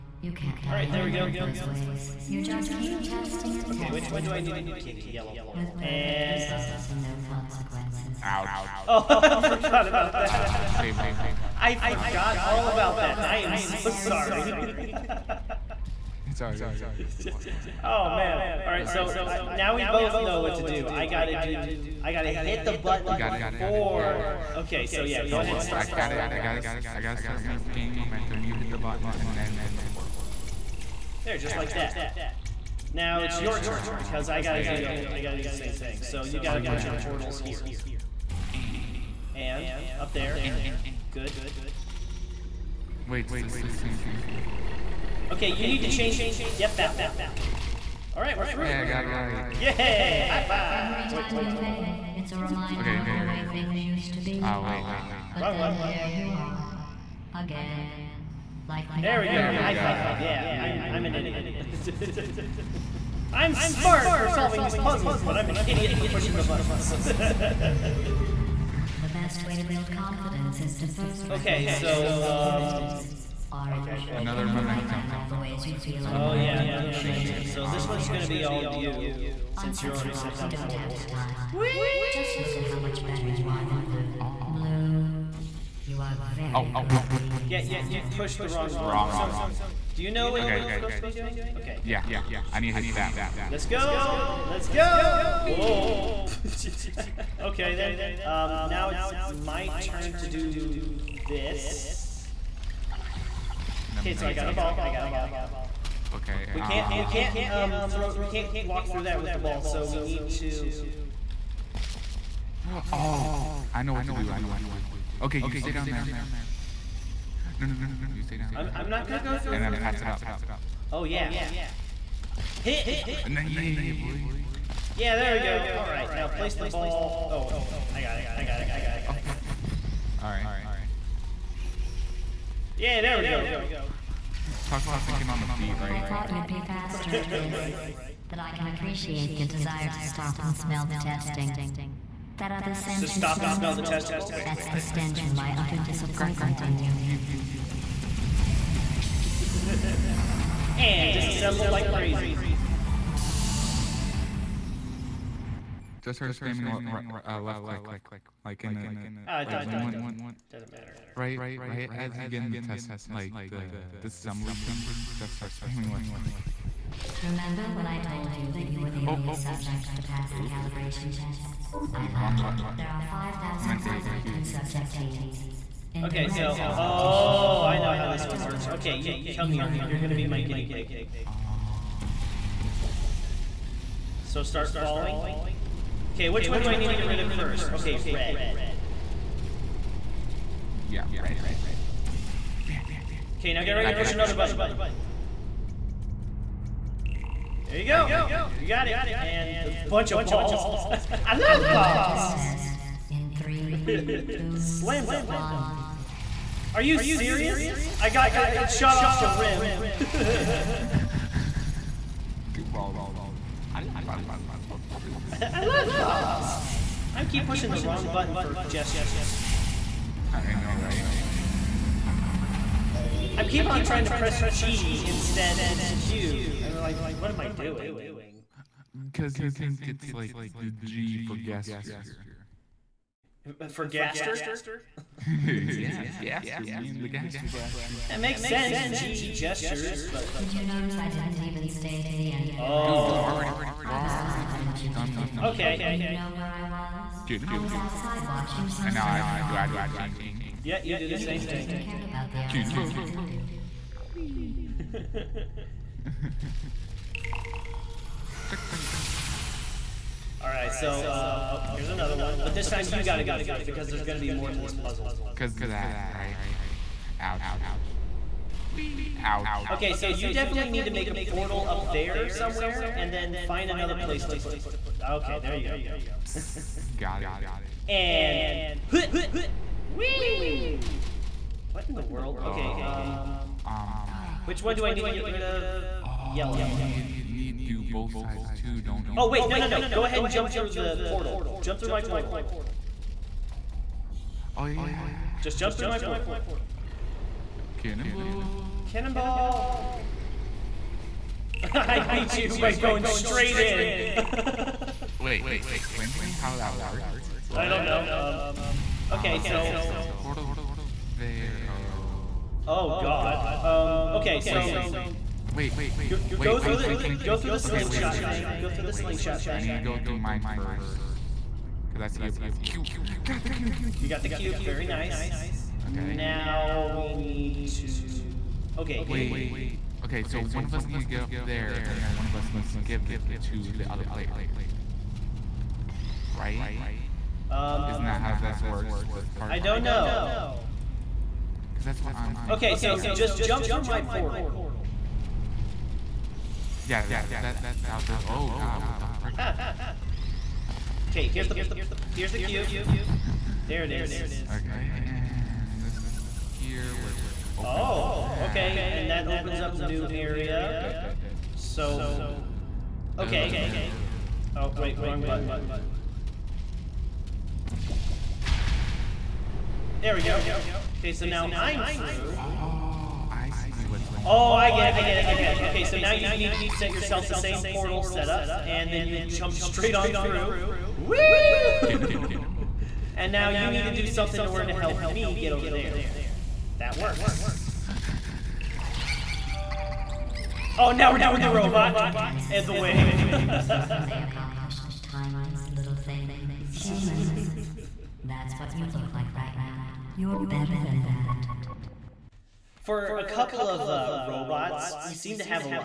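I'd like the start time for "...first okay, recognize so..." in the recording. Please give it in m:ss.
1:10.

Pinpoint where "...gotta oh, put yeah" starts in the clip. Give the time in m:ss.
0:36.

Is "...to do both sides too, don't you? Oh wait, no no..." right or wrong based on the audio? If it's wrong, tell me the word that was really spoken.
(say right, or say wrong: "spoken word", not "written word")
right.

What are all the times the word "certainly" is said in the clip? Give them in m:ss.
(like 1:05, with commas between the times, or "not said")
not said.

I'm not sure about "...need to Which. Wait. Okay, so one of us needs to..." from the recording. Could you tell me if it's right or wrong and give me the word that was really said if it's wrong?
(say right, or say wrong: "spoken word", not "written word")
wrong: "Okay", not "Which".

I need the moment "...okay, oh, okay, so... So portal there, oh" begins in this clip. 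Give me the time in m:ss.
5:09.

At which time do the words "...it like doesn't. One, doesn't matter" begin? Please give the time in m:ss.
2:39.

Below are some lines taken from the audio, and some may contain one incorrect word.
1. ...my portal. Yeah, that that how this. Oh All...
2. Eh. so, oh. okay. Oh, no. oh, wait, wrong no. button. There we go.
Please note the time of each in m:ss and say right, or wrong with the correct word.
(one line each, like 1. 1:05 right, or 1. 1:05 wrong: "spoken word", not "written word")
1. 5:43 wrong: "God", not "All"
2. 6:00 right.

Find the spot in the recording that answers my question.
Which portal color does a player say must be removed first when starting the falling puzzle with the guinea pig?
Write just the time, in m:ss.
3:08.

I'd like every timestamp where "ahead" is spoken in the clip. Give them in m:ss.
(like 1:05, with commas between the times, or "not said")
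0:25, 4:50.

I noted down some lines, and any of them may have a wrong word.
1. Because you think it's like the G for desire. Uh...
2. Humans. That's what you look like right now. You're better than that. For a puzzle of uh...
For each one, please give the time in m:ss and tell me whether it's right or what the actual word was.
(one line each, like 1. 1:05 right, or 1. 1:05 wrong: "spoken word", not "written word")
1. 3:49 wrong: "gesture", not "desire"
2. 6:36 wrong: "couple", not "puzzle".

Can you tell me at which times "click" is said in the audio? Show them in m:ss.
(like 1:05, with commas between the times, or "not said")
2:37, 2:46.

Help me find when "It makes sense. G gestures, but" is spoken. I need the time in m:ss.
3:58.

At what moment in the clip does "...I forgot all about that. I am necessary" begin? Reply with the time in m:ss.
0:11.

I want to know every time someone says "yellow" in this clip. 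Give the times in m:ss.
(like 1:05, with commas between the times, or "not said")
0:05, 4:46.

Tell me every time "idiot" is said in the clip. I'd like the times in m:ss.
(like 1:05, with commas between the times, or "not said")
1:01, 1:05.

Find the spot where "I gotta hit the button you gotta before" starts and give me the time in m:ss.
0:22.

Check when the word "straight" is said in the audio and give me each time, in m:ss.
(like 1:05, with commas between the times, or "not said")
5:03, 6:19.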